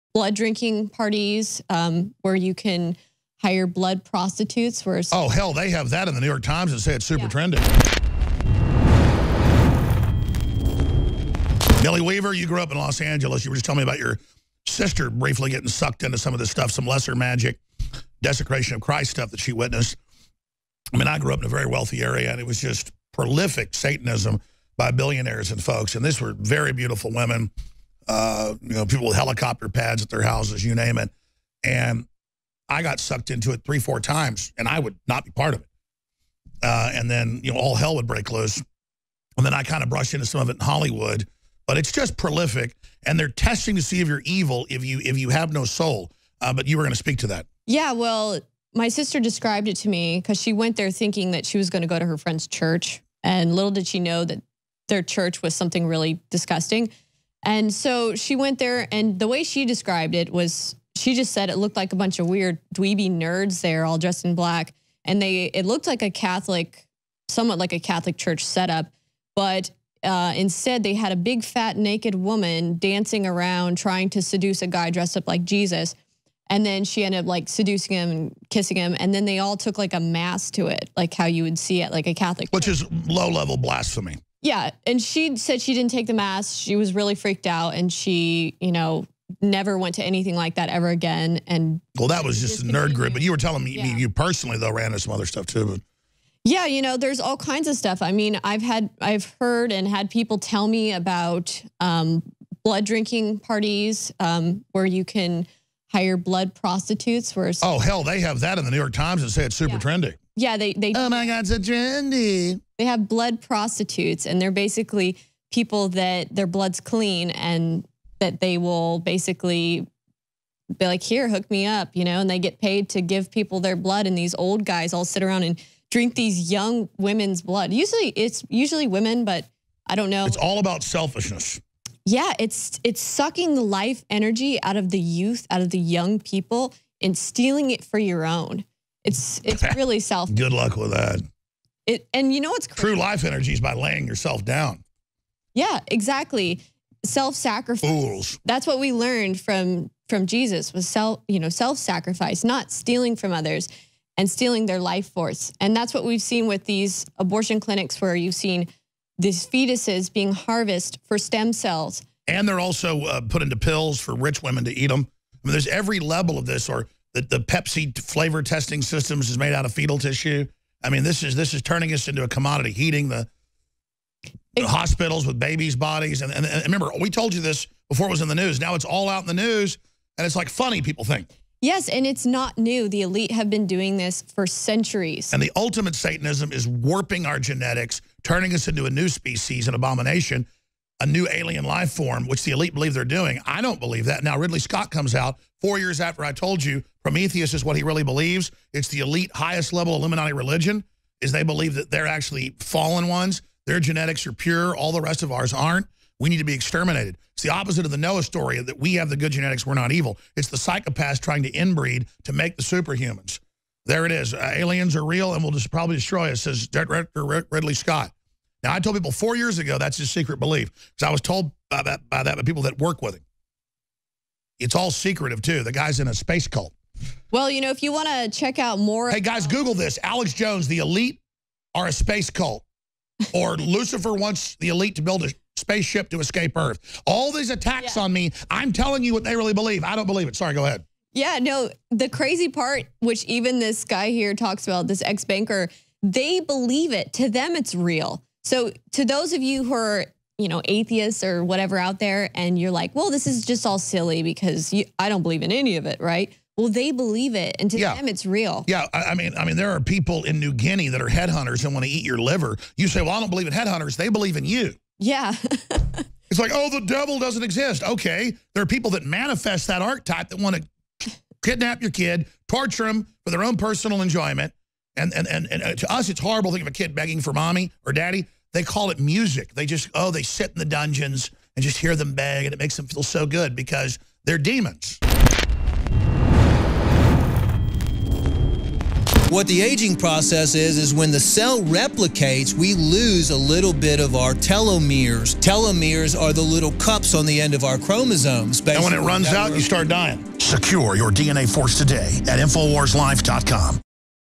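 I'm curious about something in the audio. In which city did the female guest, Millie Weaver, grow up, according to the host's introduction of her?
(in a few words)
Los Angeles.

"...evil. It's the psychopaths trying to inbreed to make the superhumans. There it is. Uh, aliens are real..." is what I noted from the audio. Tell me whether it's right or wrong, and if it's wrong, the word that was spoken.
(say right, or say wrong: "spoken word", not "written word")
right.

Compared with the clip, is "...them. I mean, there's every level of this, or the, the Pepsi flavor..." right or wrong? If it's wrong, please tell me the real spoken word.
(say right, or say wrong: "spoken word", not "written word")
right.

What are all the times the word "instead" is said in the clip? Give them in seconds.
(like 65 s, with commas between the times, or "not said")
70 s.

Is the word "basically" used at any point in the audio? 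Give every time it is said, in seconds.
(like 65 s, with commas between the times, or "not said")
114 s, 118 s.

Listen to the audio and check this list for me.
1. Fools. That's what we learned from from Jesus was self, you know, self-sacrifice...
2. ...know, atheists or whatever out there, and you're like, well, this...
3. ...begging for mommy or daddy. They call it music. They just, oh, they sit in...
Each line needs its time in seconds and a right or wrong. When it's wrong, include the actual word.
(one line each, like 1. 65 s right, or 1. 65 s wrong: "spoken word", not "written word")
1. 147 s right
2. 250 s right
3. 276 s right.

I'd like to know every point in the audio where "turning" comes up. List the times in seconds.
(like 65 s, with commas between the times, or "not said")
171 s, 188 s.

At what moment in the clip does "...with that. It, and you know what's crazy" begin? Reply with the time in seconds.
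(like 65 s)
140 s.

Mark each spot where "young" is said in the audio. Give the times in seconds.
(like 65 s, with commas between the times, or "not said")
126 s, 135 s.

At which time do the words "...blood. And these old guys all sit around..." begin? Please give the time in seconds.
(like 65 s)
123 s.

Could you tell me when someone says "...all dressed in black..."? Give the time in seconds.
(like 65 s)
63 s.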